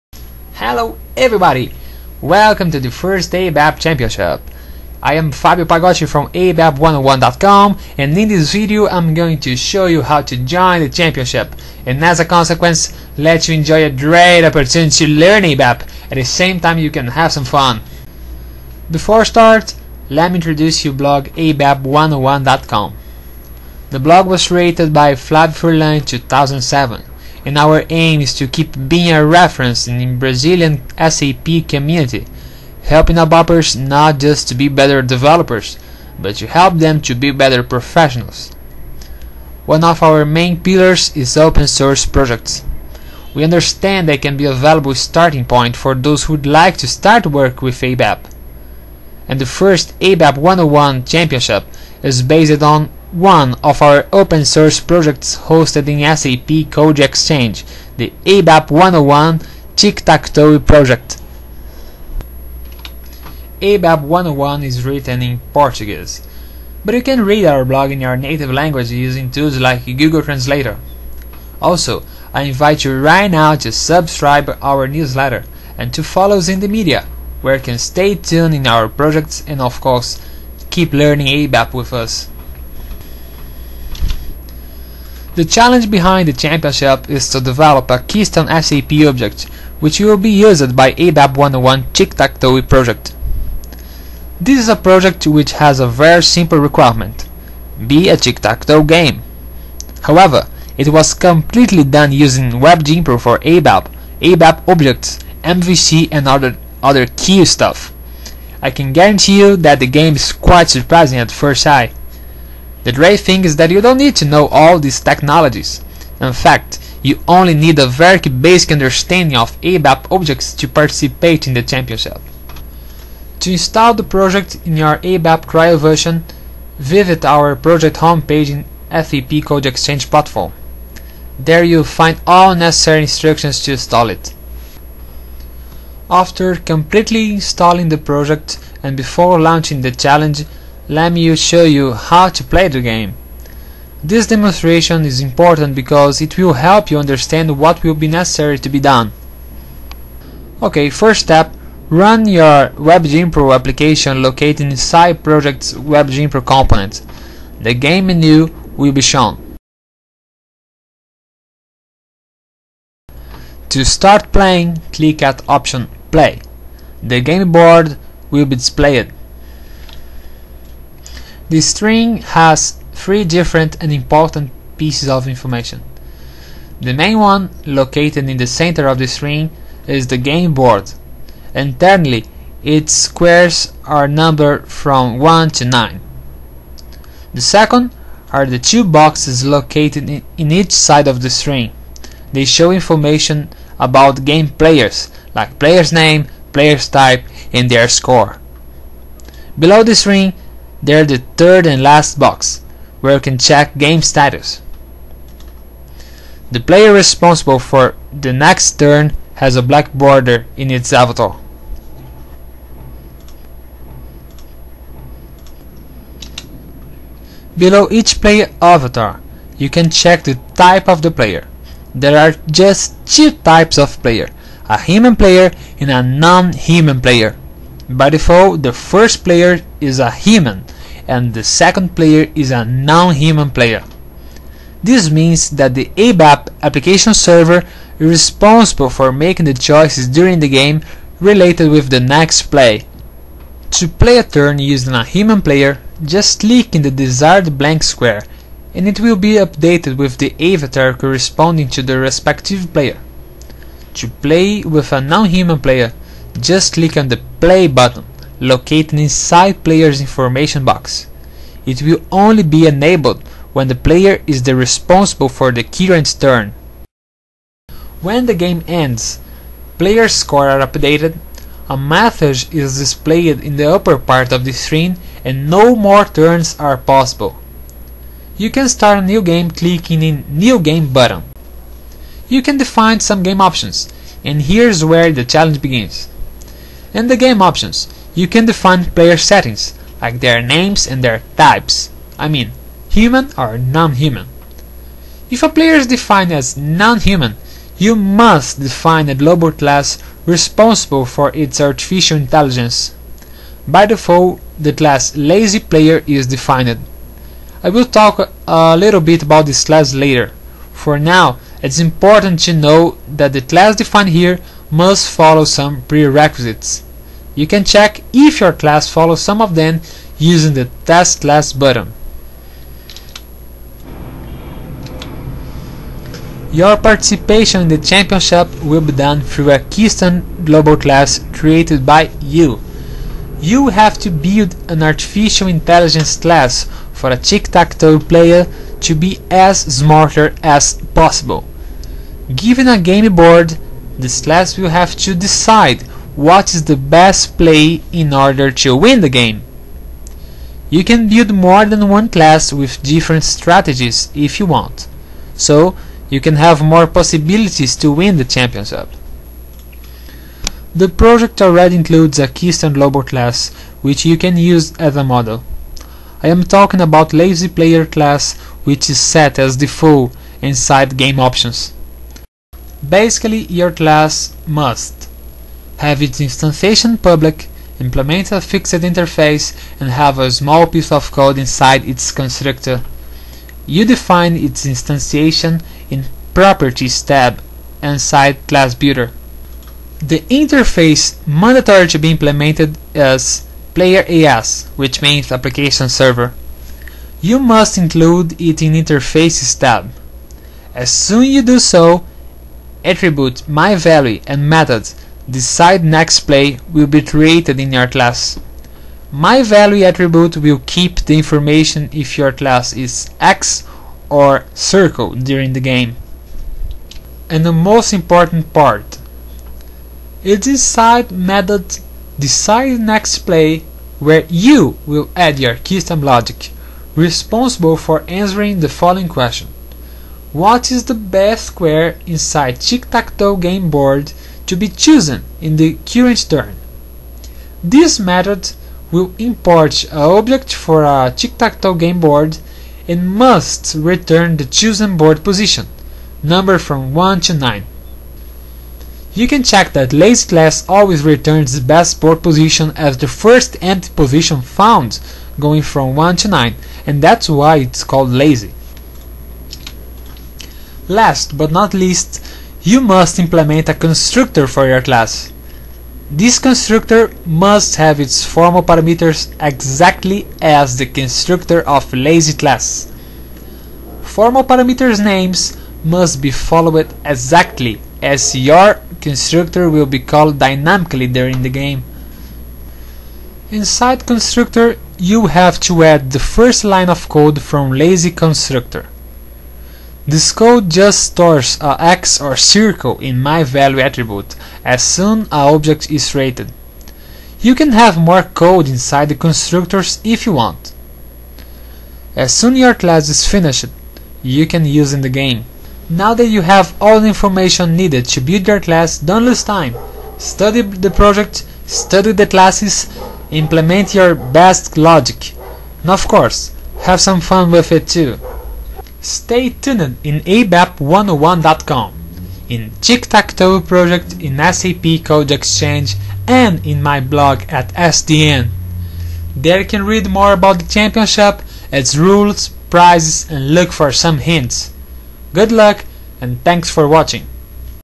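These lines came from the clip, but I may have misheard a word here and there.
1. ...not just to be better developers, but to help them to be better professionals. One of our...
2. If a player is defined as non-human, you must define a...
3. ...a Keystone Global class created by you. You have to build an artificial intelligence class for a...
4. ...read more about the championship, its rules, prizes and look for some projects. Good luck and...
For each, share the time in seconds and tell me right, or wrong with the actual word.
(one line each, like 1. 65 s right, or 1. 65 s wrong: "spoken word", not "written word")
1. 33 s right
2. 295 s right
3. 329 s right
4. 529 s wrong: "hints", not "projects".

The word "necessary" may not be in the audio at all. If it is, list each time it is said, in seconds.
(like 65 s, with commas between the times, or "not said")
132 s, 148 s.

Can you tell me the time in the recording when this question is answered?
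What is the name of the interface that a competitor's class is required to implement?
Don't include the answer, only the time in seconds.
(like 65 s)
393 s.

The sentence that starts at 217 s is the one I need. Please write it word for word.
Below each player avatar, you can check the type of the player.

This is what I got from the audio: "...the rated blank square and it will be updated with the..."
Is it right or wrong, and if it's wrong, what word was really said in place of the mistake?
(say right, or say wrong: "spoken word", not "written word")
wrong: "desired", not "rated".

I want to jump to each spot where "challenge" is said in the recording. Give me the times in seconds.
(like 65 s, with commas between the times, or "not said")
85 s, 139 s, 285 s.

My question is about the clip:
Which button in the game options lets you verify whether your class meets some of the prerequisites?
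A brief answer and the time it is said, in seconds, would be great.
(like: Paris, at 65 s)
Test Class, at 320 s.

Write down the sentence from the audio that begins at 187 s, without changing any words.
The second are the two boxes located in, in each side of the string.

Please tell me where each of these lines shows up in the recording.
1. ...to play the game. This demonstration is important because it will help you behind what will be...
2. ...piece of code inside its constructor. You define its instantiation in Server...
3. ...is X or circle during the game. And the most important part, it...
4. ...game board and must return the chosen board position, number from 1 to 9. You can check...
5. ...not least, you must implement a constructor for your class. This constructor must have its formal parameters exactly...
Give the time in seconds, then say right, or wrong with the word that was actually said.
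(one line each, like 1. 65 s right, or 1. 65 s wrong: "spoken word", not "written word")
1. 142 s wrong: "understand", not "behind"
2. 380 s wrong: "Properties", not "Server"
3. 412 s right
4. 441 s right
5. 461 s right.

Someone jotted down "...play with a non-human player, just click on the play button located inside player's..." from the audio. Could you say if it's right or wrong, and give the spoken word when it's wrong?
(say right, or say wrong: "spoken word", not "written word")
right.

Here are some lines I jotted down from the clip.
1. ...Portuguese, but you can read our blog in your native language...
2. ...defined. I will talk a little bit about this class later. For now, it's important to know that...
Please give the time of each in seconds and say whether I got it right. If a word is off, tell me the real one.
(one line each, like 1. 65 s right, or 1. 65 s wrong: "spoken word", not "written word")
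1. 65 s right
2. 306 s right.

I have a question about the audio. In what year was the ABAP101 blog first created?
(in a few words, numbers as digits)
2007.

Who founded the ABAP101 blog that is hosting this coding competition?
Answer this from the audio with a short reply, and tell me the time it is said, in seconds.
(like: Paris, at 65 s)
Flavio Furlan, at 25 s.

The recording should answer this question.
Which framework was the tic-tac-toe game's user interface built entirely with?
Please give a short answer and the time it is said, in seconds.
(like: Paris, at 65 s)
Web Dynpro for ABAP, at 102 s.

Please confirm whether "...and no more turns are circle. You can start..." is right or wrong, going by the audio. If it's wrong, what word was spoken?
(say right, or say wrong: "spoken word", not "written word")
wrong: "possible", not "circle".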